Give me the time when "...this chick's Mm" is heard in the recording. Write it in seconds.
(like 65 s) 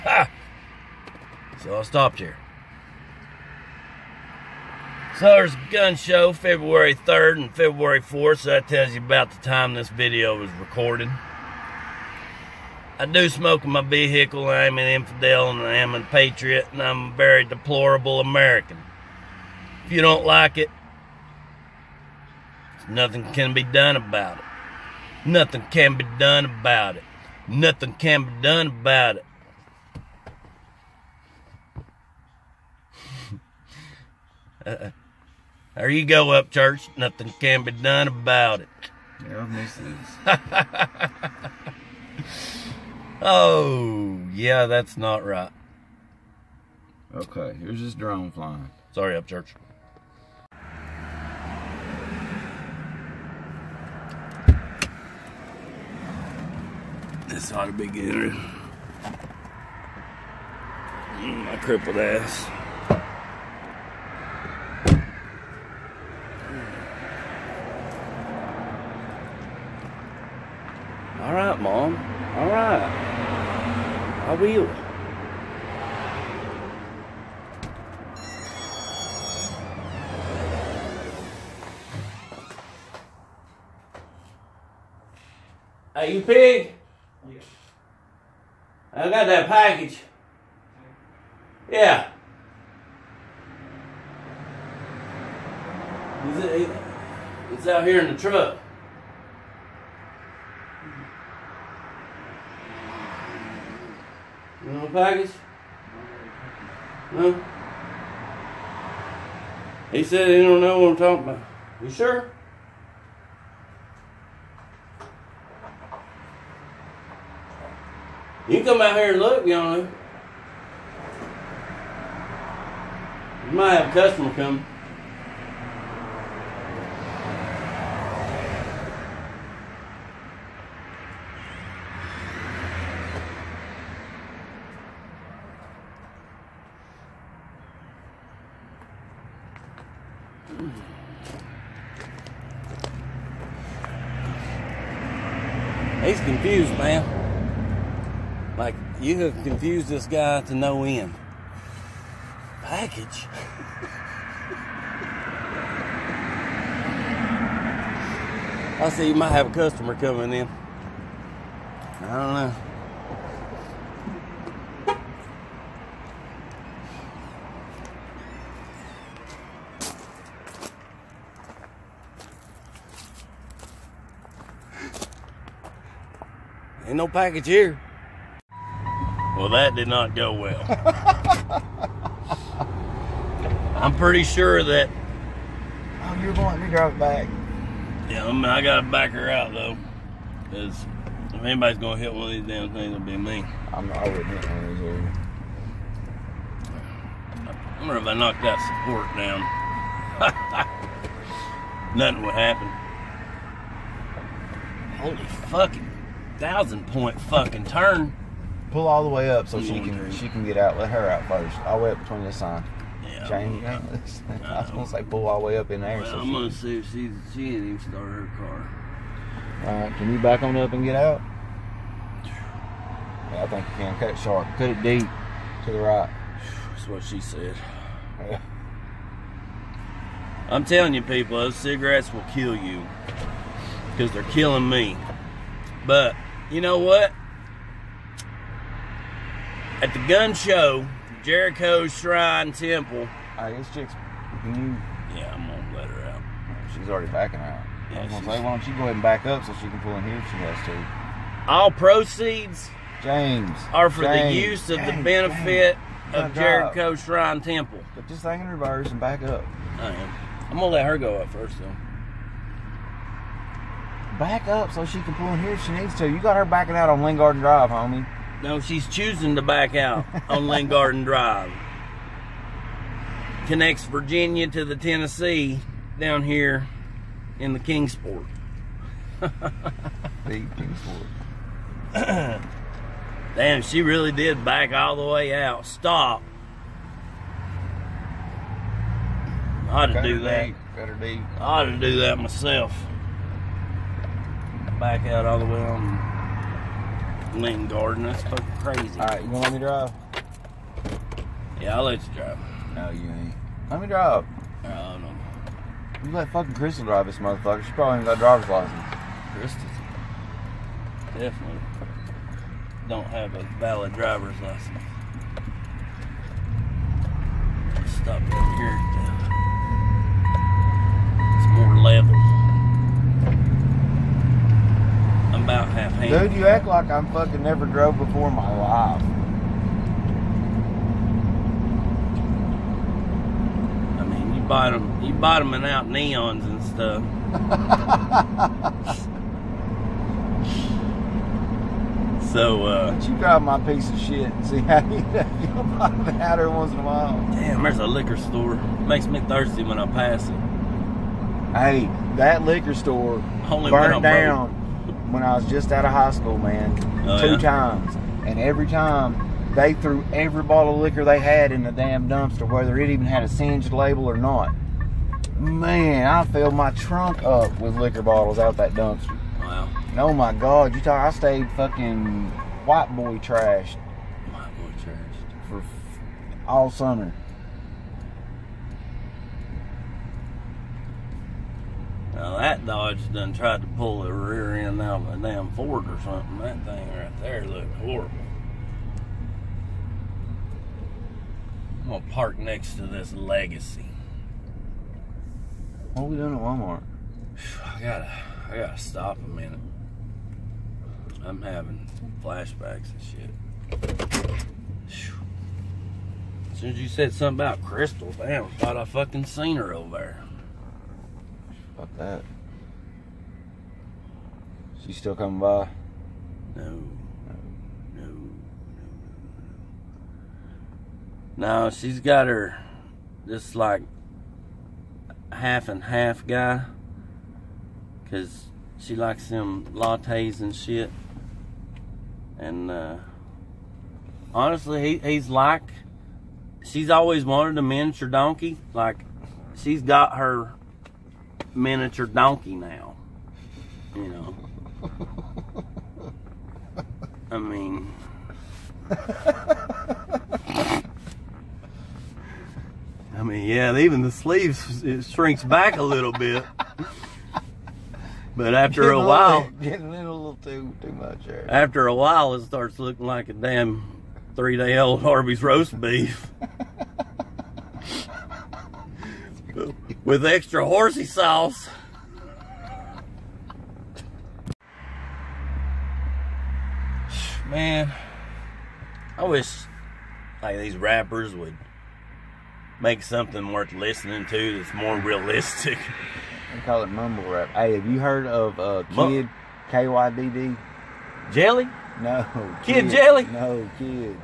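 243 s.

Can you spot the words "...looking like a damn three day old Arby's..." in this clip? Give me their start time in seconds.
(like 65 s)
462 s.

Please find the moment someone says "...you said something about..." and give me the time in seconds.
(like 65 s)
406 s.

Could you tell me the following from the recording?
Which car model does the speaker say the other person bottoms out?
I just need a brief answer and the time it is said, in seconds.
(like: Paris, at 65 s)
Neons, at 335 s.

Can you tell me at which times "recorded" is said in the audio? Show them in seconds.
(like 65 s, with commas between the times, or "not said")
10 s.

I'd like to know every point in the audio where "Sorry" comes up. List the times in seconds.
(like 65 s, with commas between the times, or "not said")
48 s.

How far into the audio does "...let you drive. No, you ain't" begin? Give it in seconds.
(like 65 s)
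301 s.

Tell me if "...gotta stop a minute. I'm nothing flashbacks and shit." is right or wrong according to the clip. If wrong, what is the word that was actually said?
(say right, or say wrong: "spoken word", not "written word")
wrong: "having", not "nothing".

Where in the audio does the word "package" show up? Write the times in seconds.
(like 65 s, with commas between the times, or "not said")
89 s, 104 s, 152 s, 177 s.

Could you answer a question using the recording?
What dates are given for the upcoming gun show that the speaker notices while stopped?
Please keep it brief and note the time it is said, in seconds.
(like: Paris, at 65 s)
February 3rd and 4th, at 6 s.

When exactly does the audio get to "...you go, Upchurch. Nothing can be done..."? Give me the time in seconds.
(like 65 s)
35 s.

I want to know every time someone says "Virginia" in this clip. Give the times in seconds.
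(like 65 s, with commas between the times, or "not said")
273 s.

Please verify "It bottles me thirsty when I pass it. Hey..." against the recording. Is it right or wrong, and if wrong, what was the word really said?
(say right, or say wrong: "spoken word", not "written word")
wrong: "makes", not "bottles".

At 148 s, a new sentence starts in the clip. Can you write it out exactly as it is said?
Like, you have confused this guy to no end.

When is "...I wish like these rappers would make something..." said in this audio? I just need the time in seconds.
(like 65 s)
479 s.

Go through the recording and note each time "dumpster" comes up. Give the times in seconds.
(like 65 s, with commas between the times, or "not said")
362 s, 368 s.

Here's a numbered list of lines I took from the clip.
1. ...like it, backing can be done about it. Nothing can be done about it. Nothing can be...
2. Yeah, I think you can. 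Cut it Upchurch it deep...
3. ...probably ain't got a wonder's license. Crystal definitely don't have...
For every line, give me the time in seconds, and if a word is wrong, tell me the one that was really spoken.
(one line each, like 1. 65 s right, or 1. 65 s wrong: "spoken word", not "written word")
1. 20 s wrong: "nothing", not "backing"
2. 223 s wrong: "Cut", not "Upchurch"
3. 307 s wrong: "driver", not "wonder".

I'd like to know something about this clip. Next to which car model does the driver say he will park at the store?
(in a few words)
Legacy.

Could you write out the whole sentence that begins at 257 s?
Put this thing in reverse and back up.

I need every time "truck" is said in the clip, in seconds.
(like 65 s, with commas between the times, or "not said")
98 s.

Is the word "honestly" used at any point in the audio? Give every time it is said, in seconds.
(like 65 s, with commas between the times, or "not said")
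434 s.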